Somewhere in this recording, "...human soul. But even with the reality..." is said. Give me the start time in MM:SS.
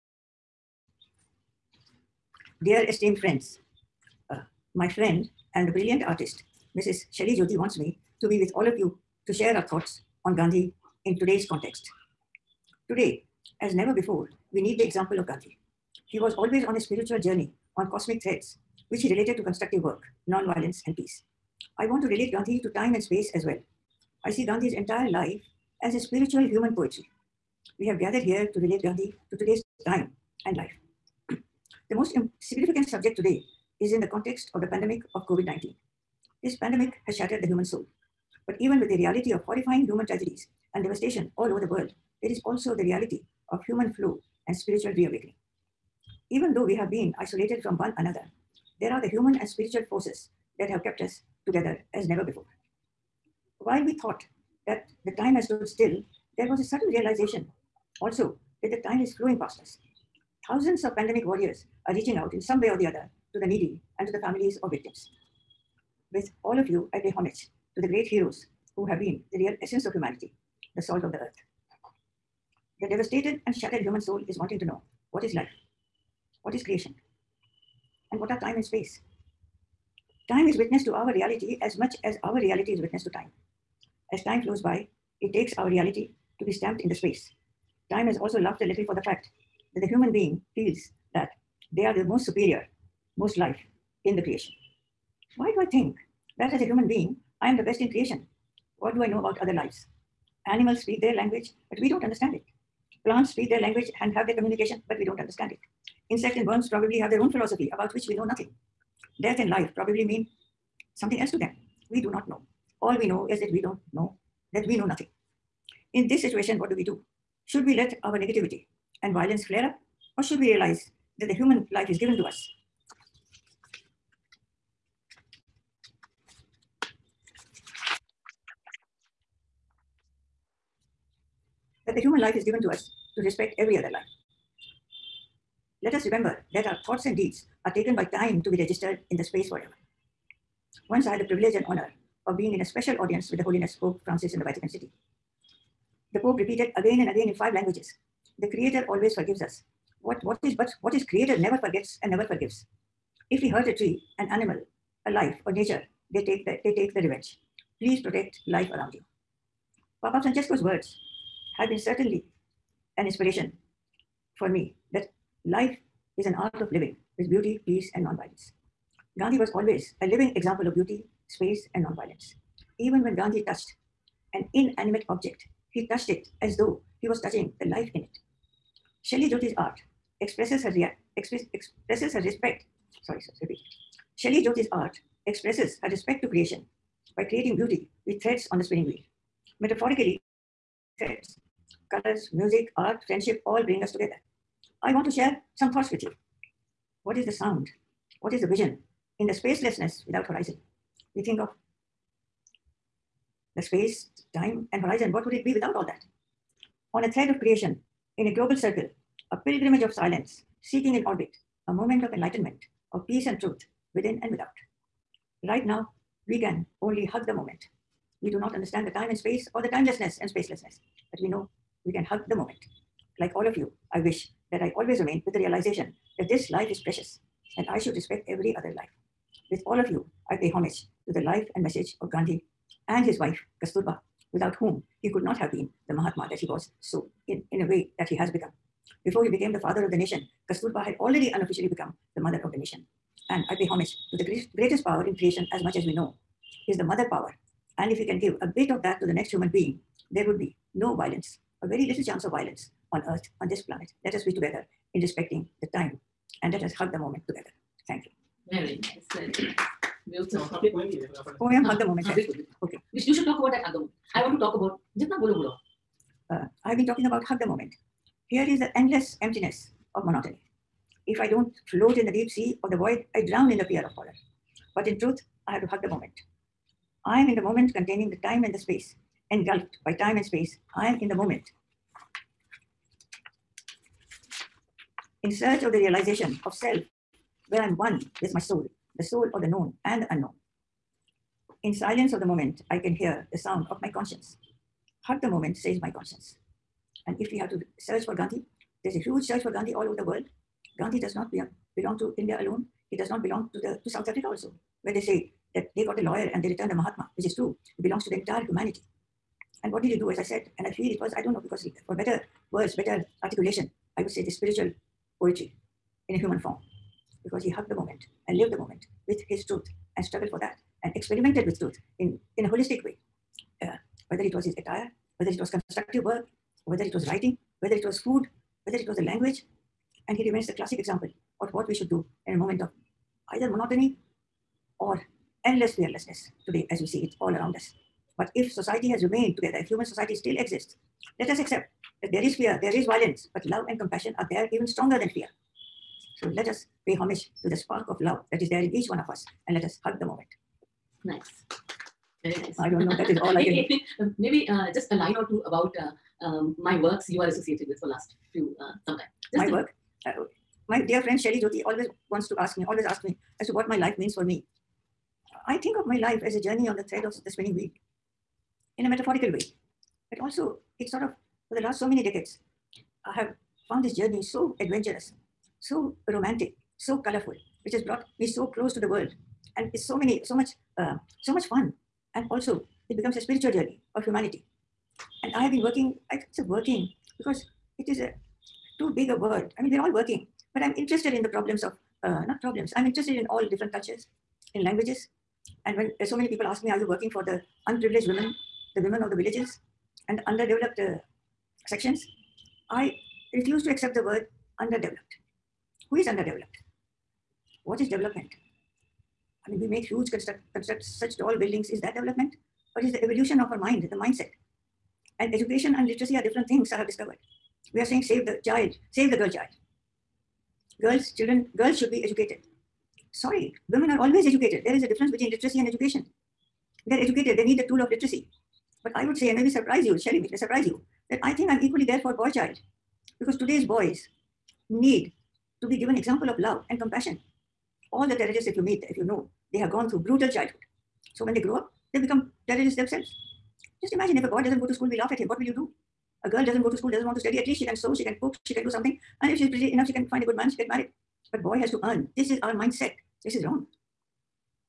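00:37.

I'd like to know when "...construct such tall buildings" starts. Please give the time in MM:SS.
06:50.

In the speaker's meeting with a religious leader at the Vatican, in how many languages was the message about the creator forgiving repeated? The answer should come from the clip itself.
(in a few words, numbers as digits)
5.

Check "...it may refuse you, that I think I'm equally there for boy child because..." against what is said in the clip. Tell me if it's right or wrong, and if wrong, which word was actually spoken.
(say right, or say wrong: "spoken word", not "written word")
wrong: "surprise", not "refuse".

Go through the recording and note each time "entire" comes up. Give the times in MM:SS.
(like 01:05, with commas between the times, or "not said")
00:24, 05:08.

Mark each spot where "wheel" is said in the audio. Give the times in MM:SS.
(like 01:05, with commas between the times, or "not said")
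03:08, 06:07.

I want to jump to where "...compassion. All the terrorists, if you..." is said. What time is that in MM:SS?
07:16.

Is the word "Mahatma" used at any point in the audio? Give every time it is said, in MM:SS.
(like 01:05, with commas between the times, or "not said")
03:55, 05:06.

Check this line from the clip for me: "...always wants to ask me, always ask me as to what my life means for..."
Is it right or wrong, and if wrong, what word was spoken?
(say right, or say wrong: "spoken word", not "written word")
right.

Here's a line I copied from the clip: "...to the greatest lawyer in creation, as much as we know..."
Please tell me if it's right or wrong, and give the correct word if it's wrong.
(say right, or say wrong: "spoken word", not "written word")
wrong: "power", not "lawyer".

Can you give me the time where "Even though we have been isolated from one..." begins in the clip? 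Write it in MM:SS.
00:46.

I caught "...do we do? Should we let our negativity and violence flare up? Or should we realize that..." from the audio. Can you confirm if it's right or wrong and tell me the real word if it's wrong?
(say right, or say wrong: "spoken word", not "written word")
right.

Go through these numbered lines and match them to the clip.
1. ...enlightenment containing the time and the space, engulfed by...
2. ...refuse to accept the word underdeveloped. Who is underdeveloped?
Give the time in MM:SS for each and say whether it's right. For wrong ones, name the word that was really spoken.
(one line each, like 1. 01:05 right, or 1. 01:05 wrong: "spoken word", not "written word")
1. 04:37 wrong: "moment", not "enlightenment"
2. 06:43 right.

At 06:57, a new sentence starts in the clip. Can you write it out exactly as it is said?
We are saying, save the child, save the girl child.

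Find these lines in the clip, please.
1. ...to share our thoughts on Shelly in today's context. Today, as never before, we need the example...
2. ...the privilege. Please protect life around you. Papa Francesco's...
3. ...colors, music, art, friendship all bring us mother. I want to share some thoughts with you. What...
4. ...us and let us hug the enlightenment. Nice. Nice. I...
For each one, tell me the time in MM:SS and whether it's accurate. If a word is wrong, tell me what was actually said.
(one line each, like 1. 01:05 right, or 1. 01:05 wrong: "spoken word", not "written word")
1. 00:09 wrong: "Gandhi", not "Shelly"
2. 02:36 wrong: "revenge", not "privilege"
3. 03:11 wrong: "together", not "mother"
4. 05:49 wrong: "moment", not "enlightenment".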